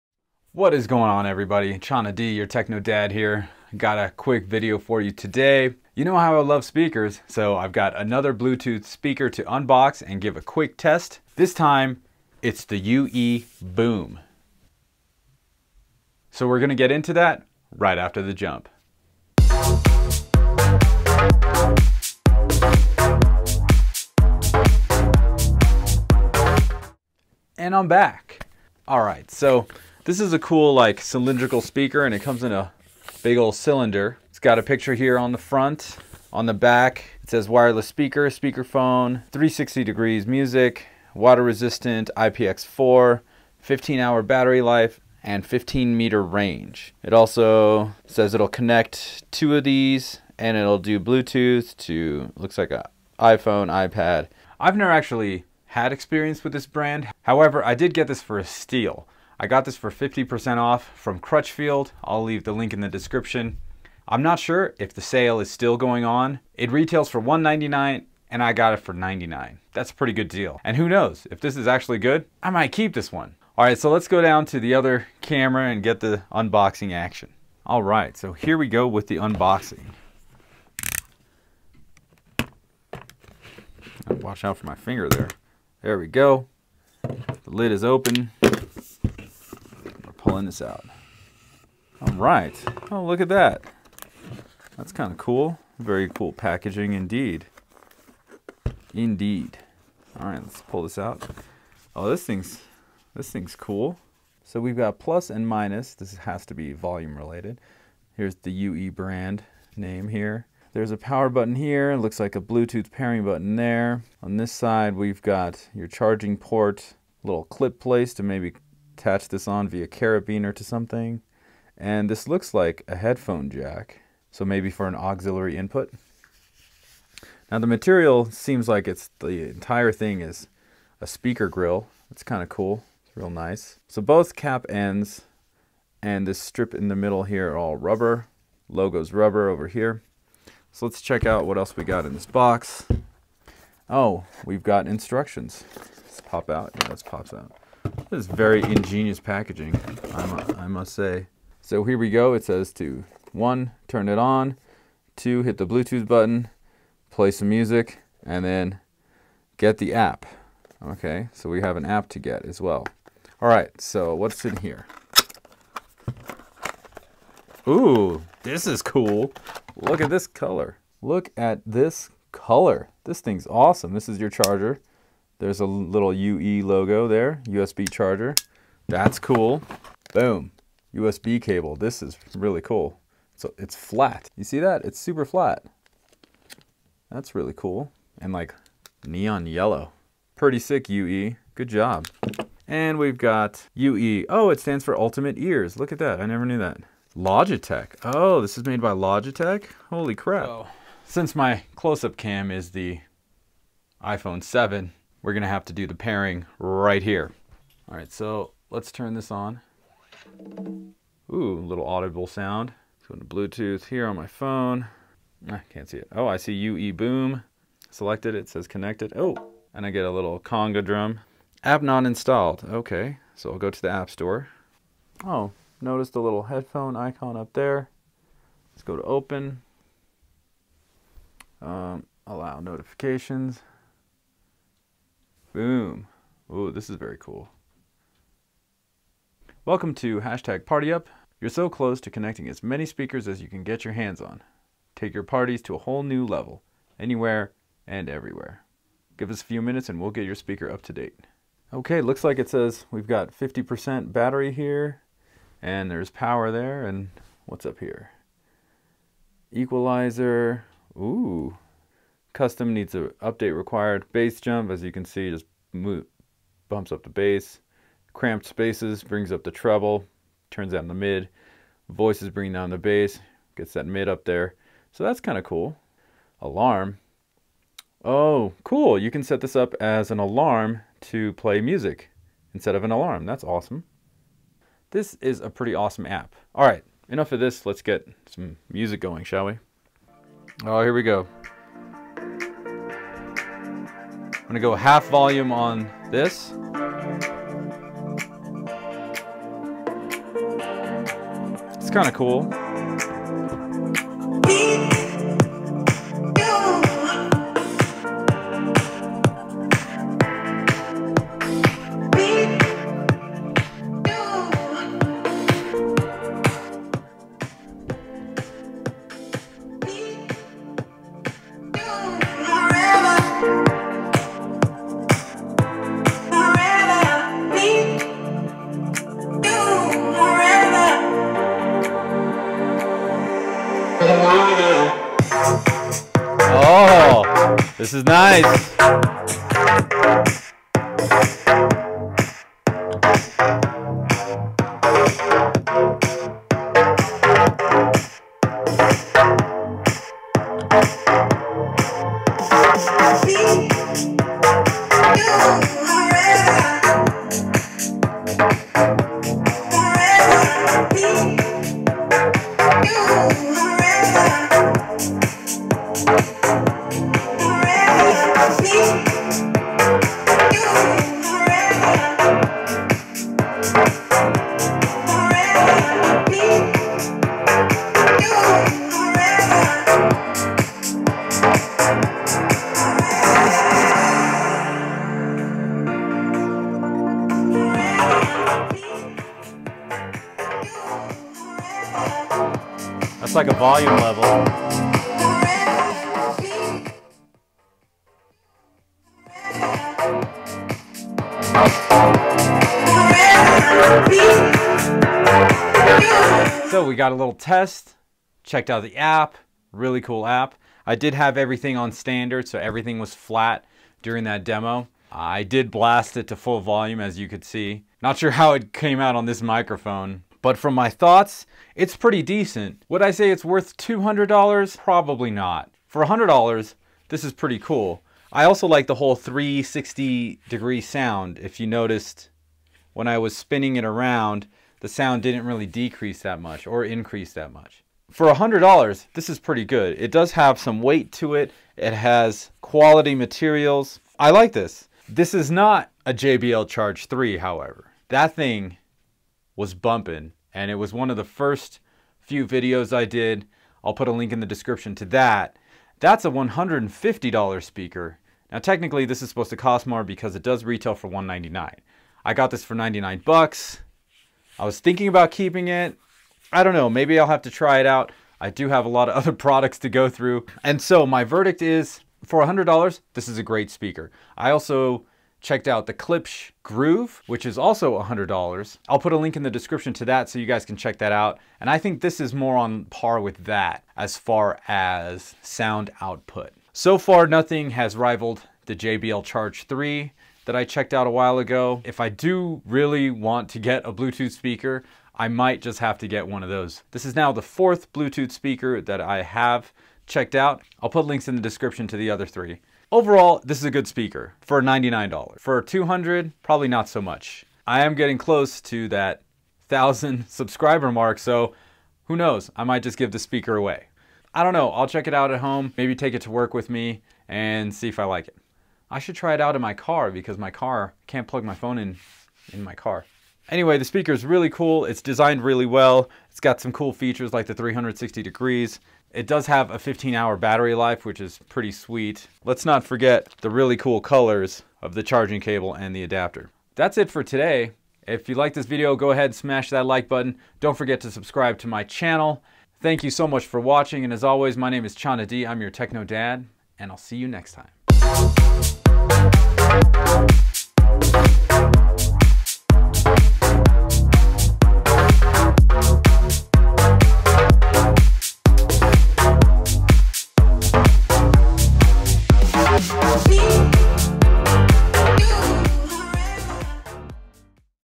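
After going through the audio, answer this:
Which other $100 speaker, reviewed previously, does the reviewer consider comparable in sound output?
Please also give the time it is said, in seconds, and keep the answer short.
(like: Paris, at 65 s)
Klipsch Groove, at 475 s.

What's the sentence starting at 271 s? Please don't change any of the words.
Voices bring down the bass, gets that mid up there.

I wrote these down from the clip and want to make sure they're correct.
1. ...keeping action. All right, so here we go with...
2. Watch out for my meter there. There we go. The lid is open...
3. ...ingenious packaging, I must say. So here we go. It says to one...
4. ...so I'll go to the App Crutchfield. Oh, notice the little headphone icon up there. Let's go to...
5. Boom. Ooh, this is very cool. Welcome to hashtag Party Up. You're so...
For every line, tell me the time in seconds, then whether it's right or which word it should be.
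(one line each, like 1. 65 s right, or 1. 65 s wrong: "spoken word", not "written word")
1. 76 s wrong: "unboxing", not "keeping"
2. 84 s wrong: "finger", not "meter"
3. 148 s right
4. 223 s wrong: "Store", not "Crutchfield"
5. 235 s right.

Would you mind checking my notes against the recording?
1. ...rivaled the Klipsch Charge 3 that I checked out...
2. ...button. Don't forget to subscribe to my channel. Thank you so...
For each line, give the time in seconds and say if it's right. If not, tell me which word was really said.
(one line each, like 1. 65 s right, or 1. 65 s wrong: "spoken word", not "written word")
1. 487 s wrong: "JBL", not "Klipsch"
2. 540 s right.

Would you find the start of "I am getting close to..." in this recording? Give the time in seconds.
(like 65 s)
507 s.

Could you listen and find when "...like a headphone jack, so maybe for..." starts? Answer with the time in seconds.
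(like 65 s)
122 s.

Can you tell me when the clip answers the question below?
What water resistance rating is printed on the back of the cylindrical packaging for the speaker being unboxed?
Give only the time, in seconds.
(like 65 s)
42 s.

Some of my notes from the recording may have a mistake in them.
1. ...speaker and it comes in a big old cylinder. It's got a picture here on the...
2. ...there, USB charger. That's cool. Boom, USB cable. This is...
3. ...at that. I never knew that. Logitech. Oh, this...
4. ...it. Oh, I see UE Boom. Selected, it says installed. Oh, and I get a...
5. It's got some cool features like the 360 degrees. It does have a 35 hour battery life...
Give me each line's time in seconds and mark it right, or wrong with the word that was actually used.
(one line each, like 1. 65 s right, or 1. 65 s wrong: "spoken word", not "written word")
1. 31 s right
2. 177 s right
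3. 195 s right
4. 215 s wrong: "connected", not "installed"
5. 526 s wrong: "15", not "35".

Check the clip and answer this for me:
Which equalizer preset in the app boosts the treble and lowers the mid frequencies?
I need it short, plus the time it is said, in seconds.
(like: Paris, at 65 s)
Cramped spaces, at 268 s.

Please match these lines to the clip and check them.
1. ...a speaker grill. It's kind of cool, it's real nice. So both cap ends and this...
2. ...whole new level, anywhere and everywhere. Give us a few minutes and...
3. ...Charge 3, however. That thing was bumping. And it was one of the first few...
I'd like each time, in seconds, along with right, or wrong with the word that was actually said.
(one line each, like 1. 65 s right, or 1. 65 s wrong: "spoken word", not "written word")
1. 131 s right
2. 245 s right
3. 446 s right.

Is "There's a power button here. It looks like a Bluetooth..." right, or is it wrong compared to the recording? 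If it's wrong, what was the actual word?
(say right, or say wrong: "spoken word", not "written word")
right.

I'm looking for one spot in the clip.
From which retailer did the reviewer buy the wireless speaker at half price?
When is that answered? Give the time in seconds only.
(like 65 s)
61 s.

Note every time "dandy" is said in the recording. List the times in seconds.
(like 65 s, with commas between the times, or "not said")
not said.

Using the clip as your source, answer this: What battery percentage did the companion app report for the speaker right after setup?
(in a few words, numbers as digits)
50%.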